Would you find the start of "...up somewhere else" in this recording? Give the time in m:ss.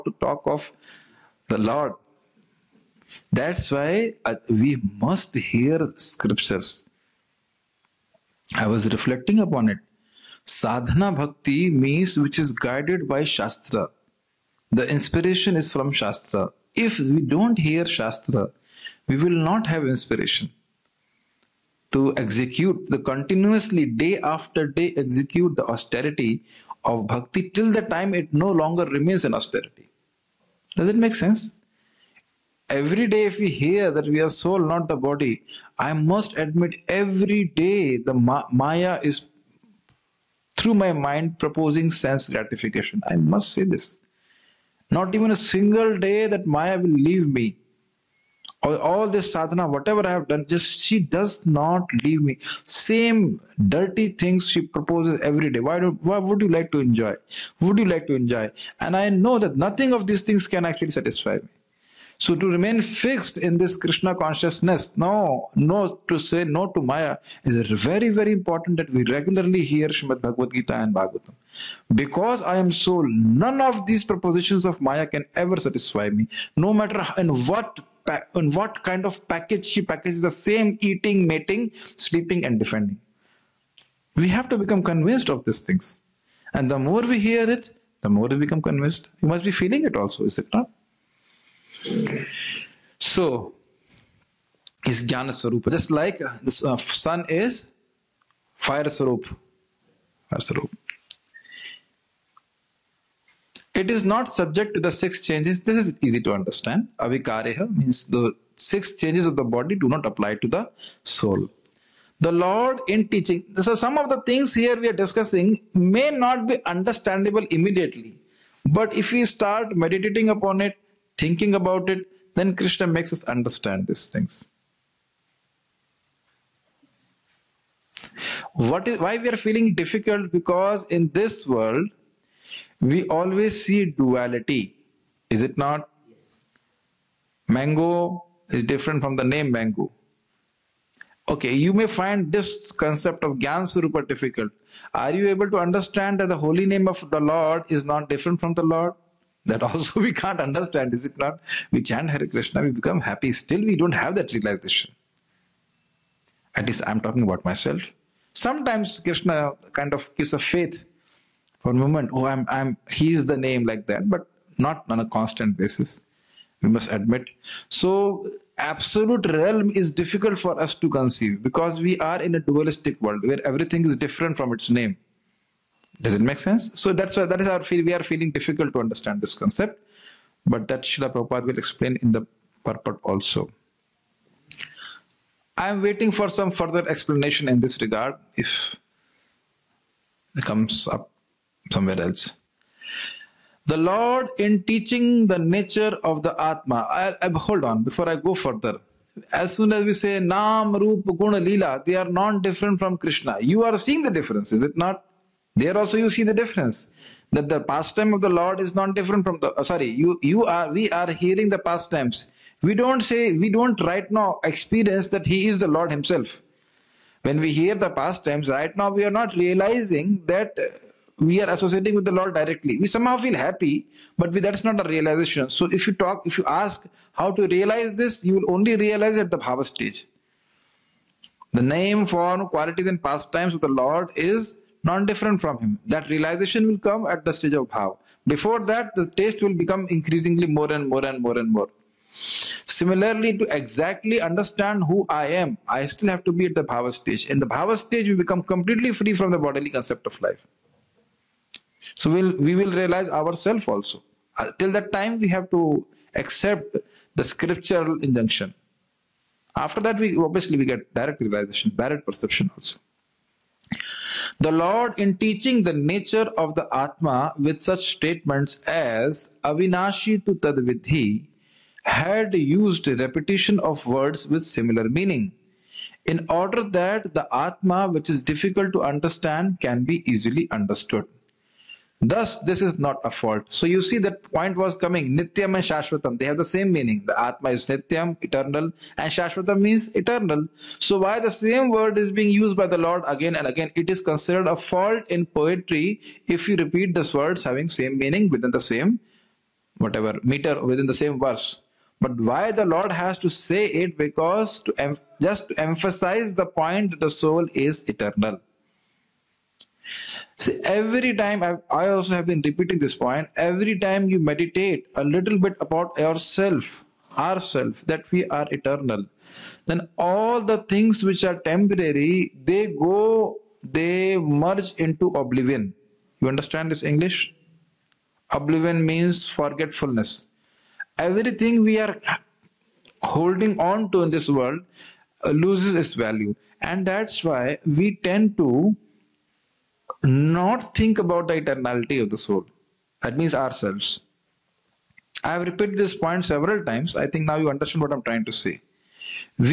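3:10.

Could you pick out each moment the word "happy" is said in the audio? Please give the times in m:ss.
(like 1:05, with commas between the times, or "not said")
2:33, 3:43.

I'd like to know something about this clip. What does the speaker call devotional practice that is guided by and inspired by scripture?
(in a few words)
Sadhana bhakti.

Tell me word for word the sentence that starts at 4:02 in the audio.
Similarly, to exactly understand who I am, I still have to be at the bhava stage.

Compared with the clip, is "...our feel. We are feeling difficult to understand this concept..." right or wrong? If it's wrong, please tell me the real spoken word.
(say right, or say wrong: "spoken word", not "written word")
right.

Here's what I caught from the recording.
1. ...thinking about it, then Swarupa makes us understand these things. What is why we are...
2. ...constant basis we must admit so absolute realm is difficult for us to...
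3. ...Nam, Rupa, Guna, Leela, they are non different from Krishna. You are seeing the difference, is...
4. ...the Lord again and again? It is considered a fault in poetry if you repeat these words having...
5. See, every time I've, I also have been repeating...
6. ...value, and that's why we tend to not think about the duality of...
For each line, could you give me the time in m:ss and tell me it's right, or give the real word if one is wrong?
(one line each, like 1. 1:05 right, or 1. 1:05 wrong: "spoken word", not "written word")
1. 2:01 wrong: "Krishna", not "Swarupa"
2. 2:45 right
3. 3:20 right
4. 4:52 right
5. 5:10 right
6. 5:35 wrong: "eternality", not "duality".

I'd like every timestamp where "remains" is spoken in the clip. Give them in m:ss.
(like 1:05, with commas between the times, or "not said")
0:28, 1:02.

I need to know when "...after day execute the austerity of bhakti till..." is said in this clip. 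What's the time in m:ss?
0:24.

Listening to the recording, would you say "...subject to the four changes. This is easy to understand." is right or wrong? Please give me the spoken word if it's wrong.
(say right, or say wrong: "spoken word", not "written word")
wrong: "six", not "four".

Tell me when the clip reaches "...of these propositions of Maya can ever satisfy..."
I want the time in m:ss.
1:13.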